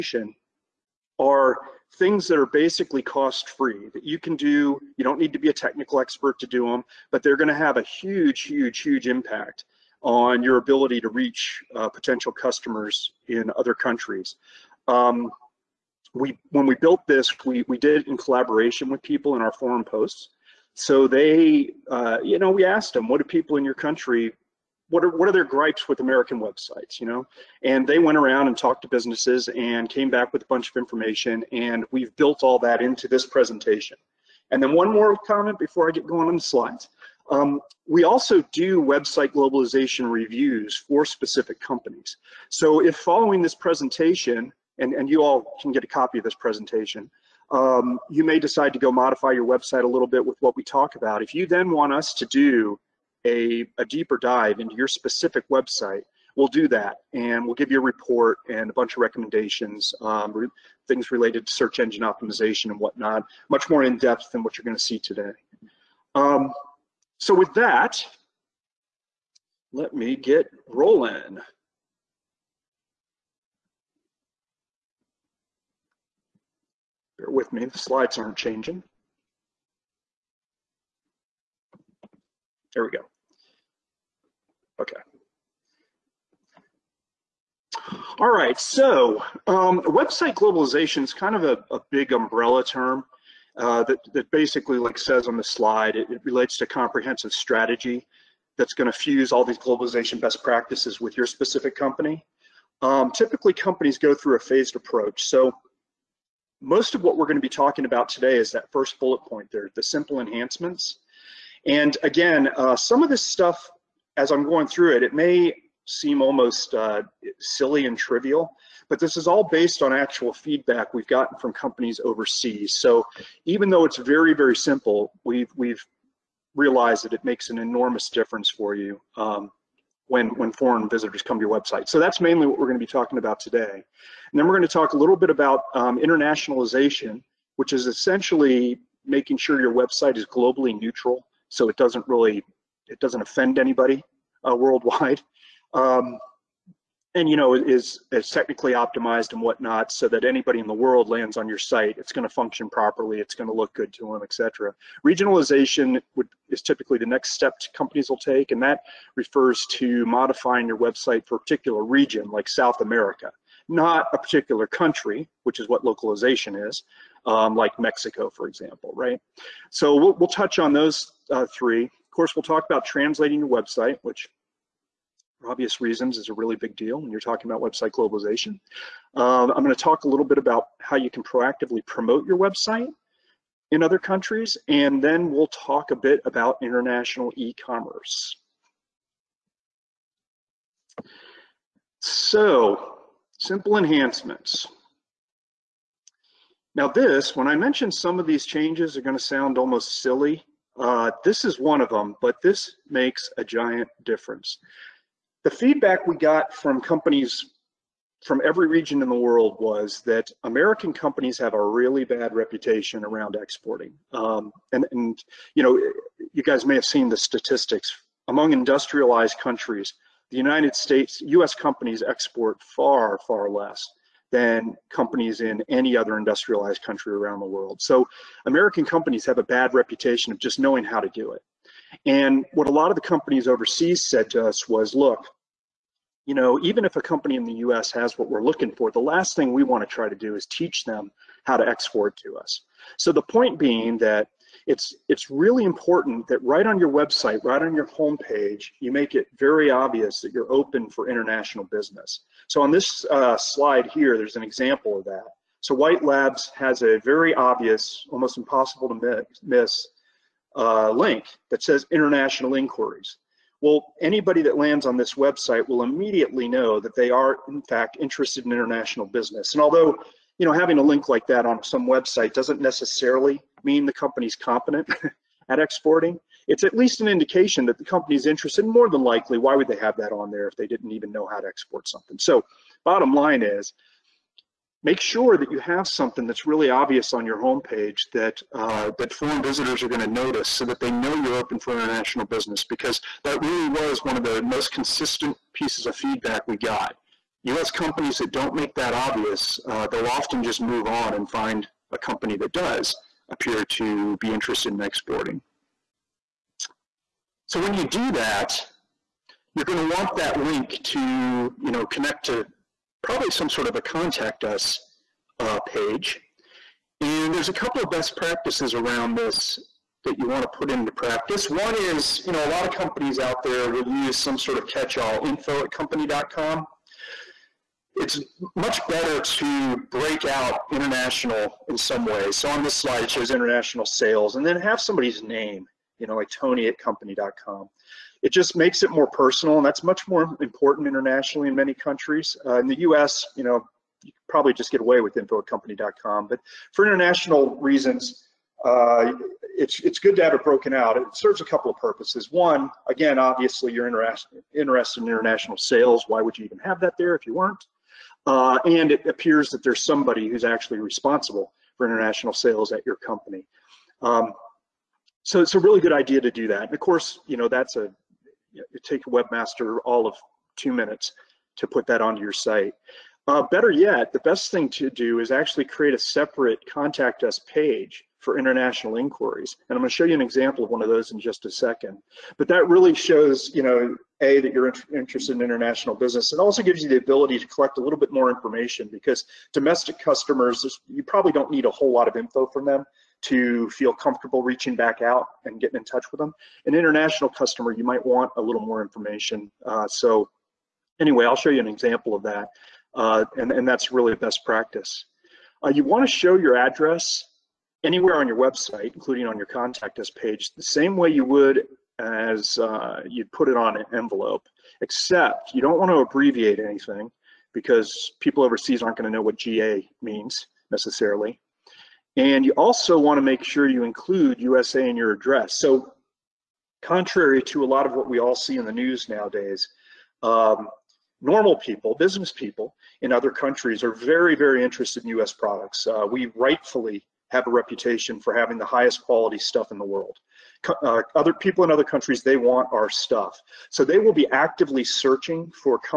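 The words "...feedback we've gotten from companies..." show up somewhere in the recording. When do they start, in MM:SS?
02:00.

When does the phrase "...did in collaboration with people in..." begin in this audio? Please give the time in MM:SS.
00:17.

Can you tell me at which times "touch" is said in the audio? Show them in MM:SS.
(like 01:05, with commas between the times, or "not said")
02:50, 06:35.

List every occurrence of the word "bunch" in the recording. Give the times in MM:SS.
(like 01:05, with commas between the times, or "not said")
00:30, 00:58.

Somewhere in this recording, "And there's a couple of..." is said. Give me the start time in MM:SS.
05:16.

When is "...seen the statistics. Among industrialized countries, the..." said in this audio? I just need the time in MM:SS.
03:36.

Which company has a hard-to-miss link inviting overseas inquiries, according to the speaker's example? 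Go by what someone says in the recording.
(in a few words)
White Labs.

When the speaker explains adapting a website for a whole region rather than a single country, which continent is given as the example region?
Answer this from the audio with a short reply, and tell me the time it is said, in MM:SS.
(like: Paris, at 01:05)
South America, at 02:42.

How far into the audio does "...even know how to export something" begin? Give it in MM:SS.
04:40.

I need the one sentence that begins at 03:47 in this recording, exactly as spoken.
So American companies have a bad reputation of just knowing how to do it.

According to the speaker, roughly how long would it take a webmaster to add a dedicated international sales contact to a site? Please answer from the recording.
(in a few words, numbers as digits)
2 minutes.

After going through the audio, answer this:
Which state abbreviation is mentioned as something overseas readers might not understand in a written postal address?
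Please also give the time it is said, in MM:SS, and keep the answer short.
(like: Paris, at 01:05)
GA, at 06:59.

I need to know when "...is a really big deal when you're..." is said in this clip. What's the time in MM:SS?
02:56.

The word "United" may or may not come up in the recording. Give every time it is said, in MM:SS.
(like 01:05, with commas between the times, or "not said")
03:40.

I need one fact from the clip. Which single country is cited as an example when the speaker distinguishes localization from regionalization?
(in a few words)
Mexico.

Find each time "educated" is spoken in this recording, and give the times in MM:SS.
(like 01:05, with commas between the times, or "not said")
not said.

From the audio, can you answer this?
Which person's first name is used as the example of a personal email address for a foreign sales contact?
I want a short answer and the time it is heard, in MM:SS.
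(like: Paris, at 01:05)
Tony, at 05:36.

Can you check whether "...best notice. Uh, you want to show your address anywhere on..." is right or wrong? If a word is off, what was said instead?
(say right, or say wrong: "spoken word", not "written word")
wrong: "practice", not "notice".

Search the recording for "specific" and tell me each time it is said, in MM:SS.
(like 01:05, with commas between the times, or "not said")
00:41, 00:54, 01:41.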